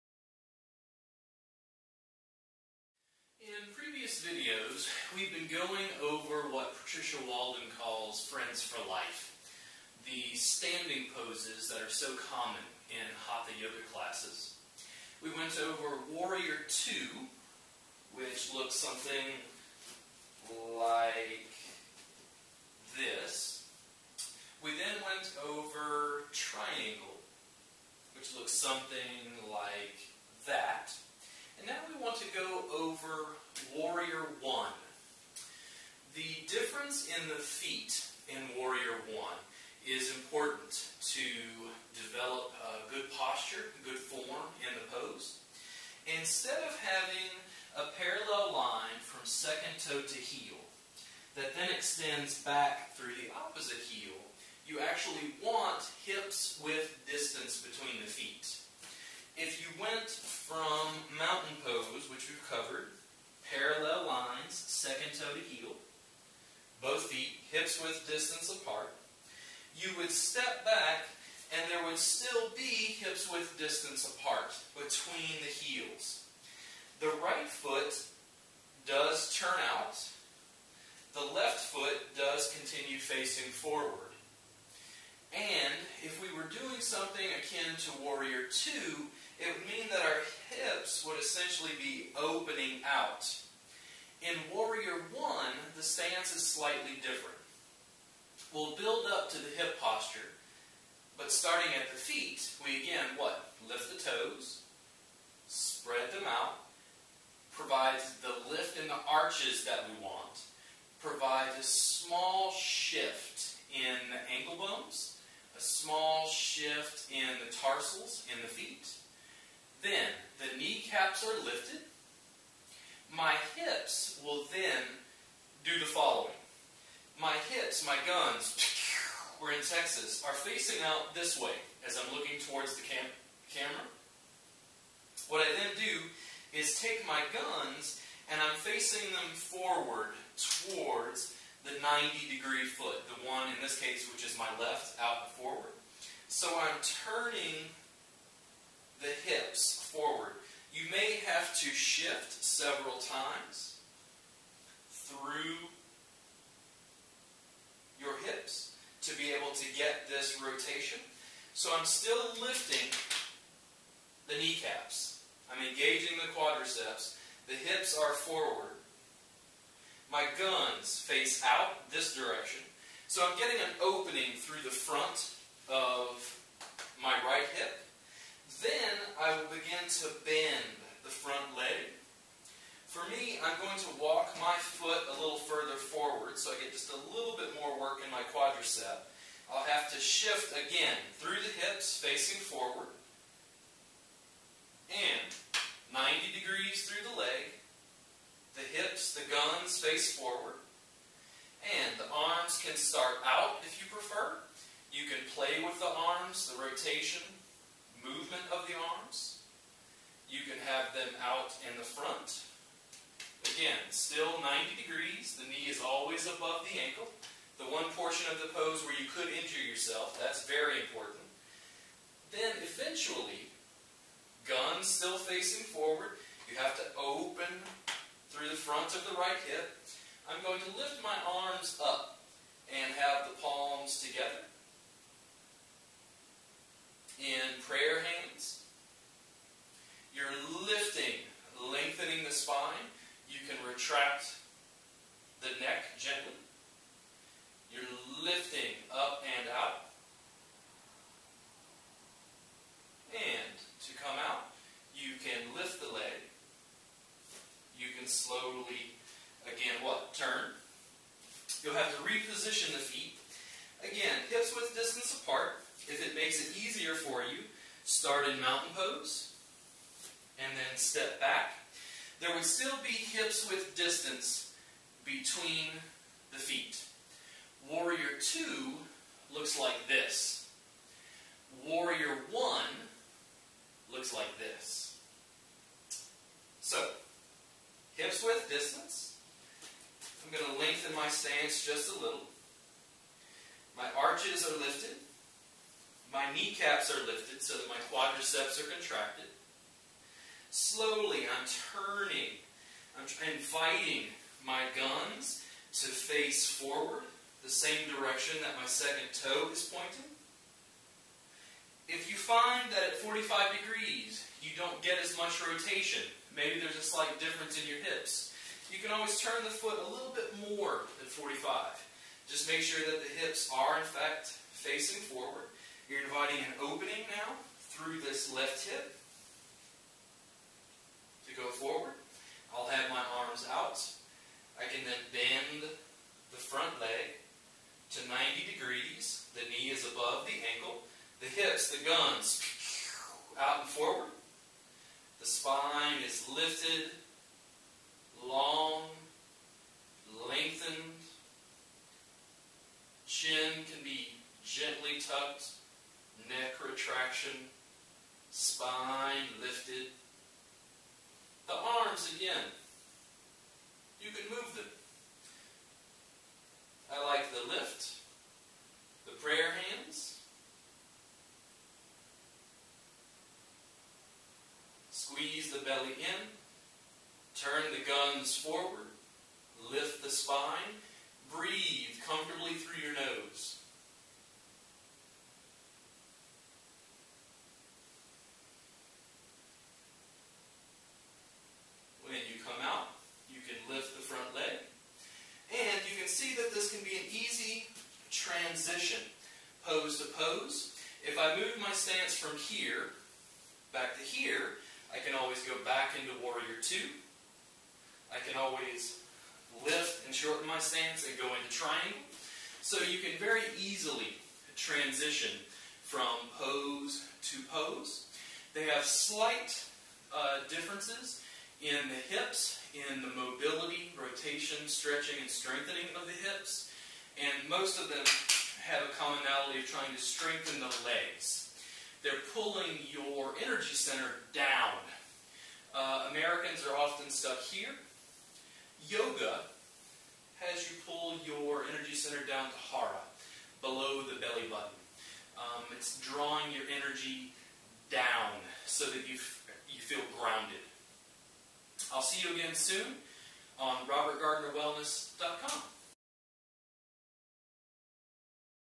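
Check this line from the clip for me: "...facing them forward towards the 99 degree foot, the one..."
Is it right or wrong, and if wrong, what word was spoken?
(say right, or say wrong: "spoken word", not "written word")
wrong: "90", not "99".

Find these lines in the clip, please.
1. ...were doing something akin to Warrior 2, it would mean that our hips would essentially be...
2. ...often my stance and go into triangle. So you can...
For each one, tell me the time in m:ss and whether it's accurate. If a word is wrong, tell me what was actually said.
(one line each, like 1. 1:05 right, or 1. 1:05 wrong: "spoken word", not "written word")
1. 1:26 right
2. 6:50 wrong: "shorten", not "often".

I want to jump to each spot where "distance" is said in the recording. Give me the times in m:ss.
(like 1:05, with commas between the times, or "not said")
0:57, 1:08, 1:13, 4:24, 4:33, 4:48.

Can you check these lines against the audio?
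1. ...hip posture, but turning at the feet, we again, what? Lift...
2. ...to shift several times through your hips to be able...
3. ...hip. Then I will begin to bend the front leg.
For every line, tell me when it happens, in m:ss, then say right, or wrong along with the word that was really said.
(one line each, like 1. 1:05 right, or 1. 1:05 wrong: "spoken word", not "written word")
1. 1:39 wrong: "starting", not "turning"
2. 2:31 right
3. 2:57 right.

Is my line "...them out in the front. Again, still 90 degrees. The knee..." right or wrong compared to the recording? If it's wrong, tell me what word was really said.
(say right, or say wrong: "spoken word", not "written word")
right.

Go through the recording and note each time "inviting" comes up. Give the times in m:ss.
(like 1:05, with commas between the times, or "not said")
5:03, 5:26.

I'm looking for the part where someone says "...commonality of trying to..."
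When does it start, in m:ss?
7:08.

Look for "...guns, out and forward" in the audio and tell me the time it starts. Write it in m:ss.
5:41.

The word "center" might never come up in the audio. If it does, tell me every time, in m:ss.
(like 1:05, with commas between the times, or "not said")
7:13, 7:21.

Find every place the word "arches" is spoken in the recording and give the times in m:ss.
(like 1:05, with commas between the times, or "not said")
1:49, 4:53.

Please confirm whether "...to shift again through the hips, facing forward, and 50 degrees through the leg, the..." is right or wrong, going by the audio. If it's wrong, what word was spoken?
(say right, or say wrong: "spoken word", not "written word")
wrong: "90", not "50".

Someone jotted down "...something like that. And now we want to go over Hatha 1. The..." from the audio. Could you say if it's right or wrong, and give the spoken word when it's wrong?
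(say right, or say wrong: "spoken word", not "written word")
wrong: "Warrior", not "Hatha".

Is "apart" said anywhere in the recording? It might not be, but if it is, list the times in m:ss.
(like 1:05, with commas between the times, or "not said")
1:08, 1:14, 4:25.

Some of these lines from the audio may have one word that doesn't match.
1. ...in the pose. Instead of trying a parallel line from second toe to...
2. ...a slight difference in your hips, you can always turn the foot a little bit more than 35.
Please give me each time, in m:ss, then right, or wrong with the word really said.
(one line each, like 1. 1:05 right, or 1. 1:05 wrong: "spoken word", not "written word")
1. 0:44 wrong: "having", not "trying"
2. 5:16 wrong: "45", not "35".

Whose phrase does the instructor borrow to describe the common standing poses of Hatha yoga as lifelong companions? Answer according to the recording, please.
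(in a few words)
Patricia Walden.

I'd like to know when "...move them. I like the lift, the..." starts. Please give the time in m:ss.
6:04.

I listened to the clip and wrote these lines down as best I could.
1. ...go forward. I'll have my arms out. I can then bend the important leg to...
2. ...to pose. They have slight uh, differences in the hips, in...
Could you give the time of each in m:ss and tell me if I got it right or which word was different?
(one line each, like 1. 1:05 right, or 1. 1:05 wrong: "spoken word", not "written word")
1. 5:31 wrong: "front", not "important"
2. 6:57 right.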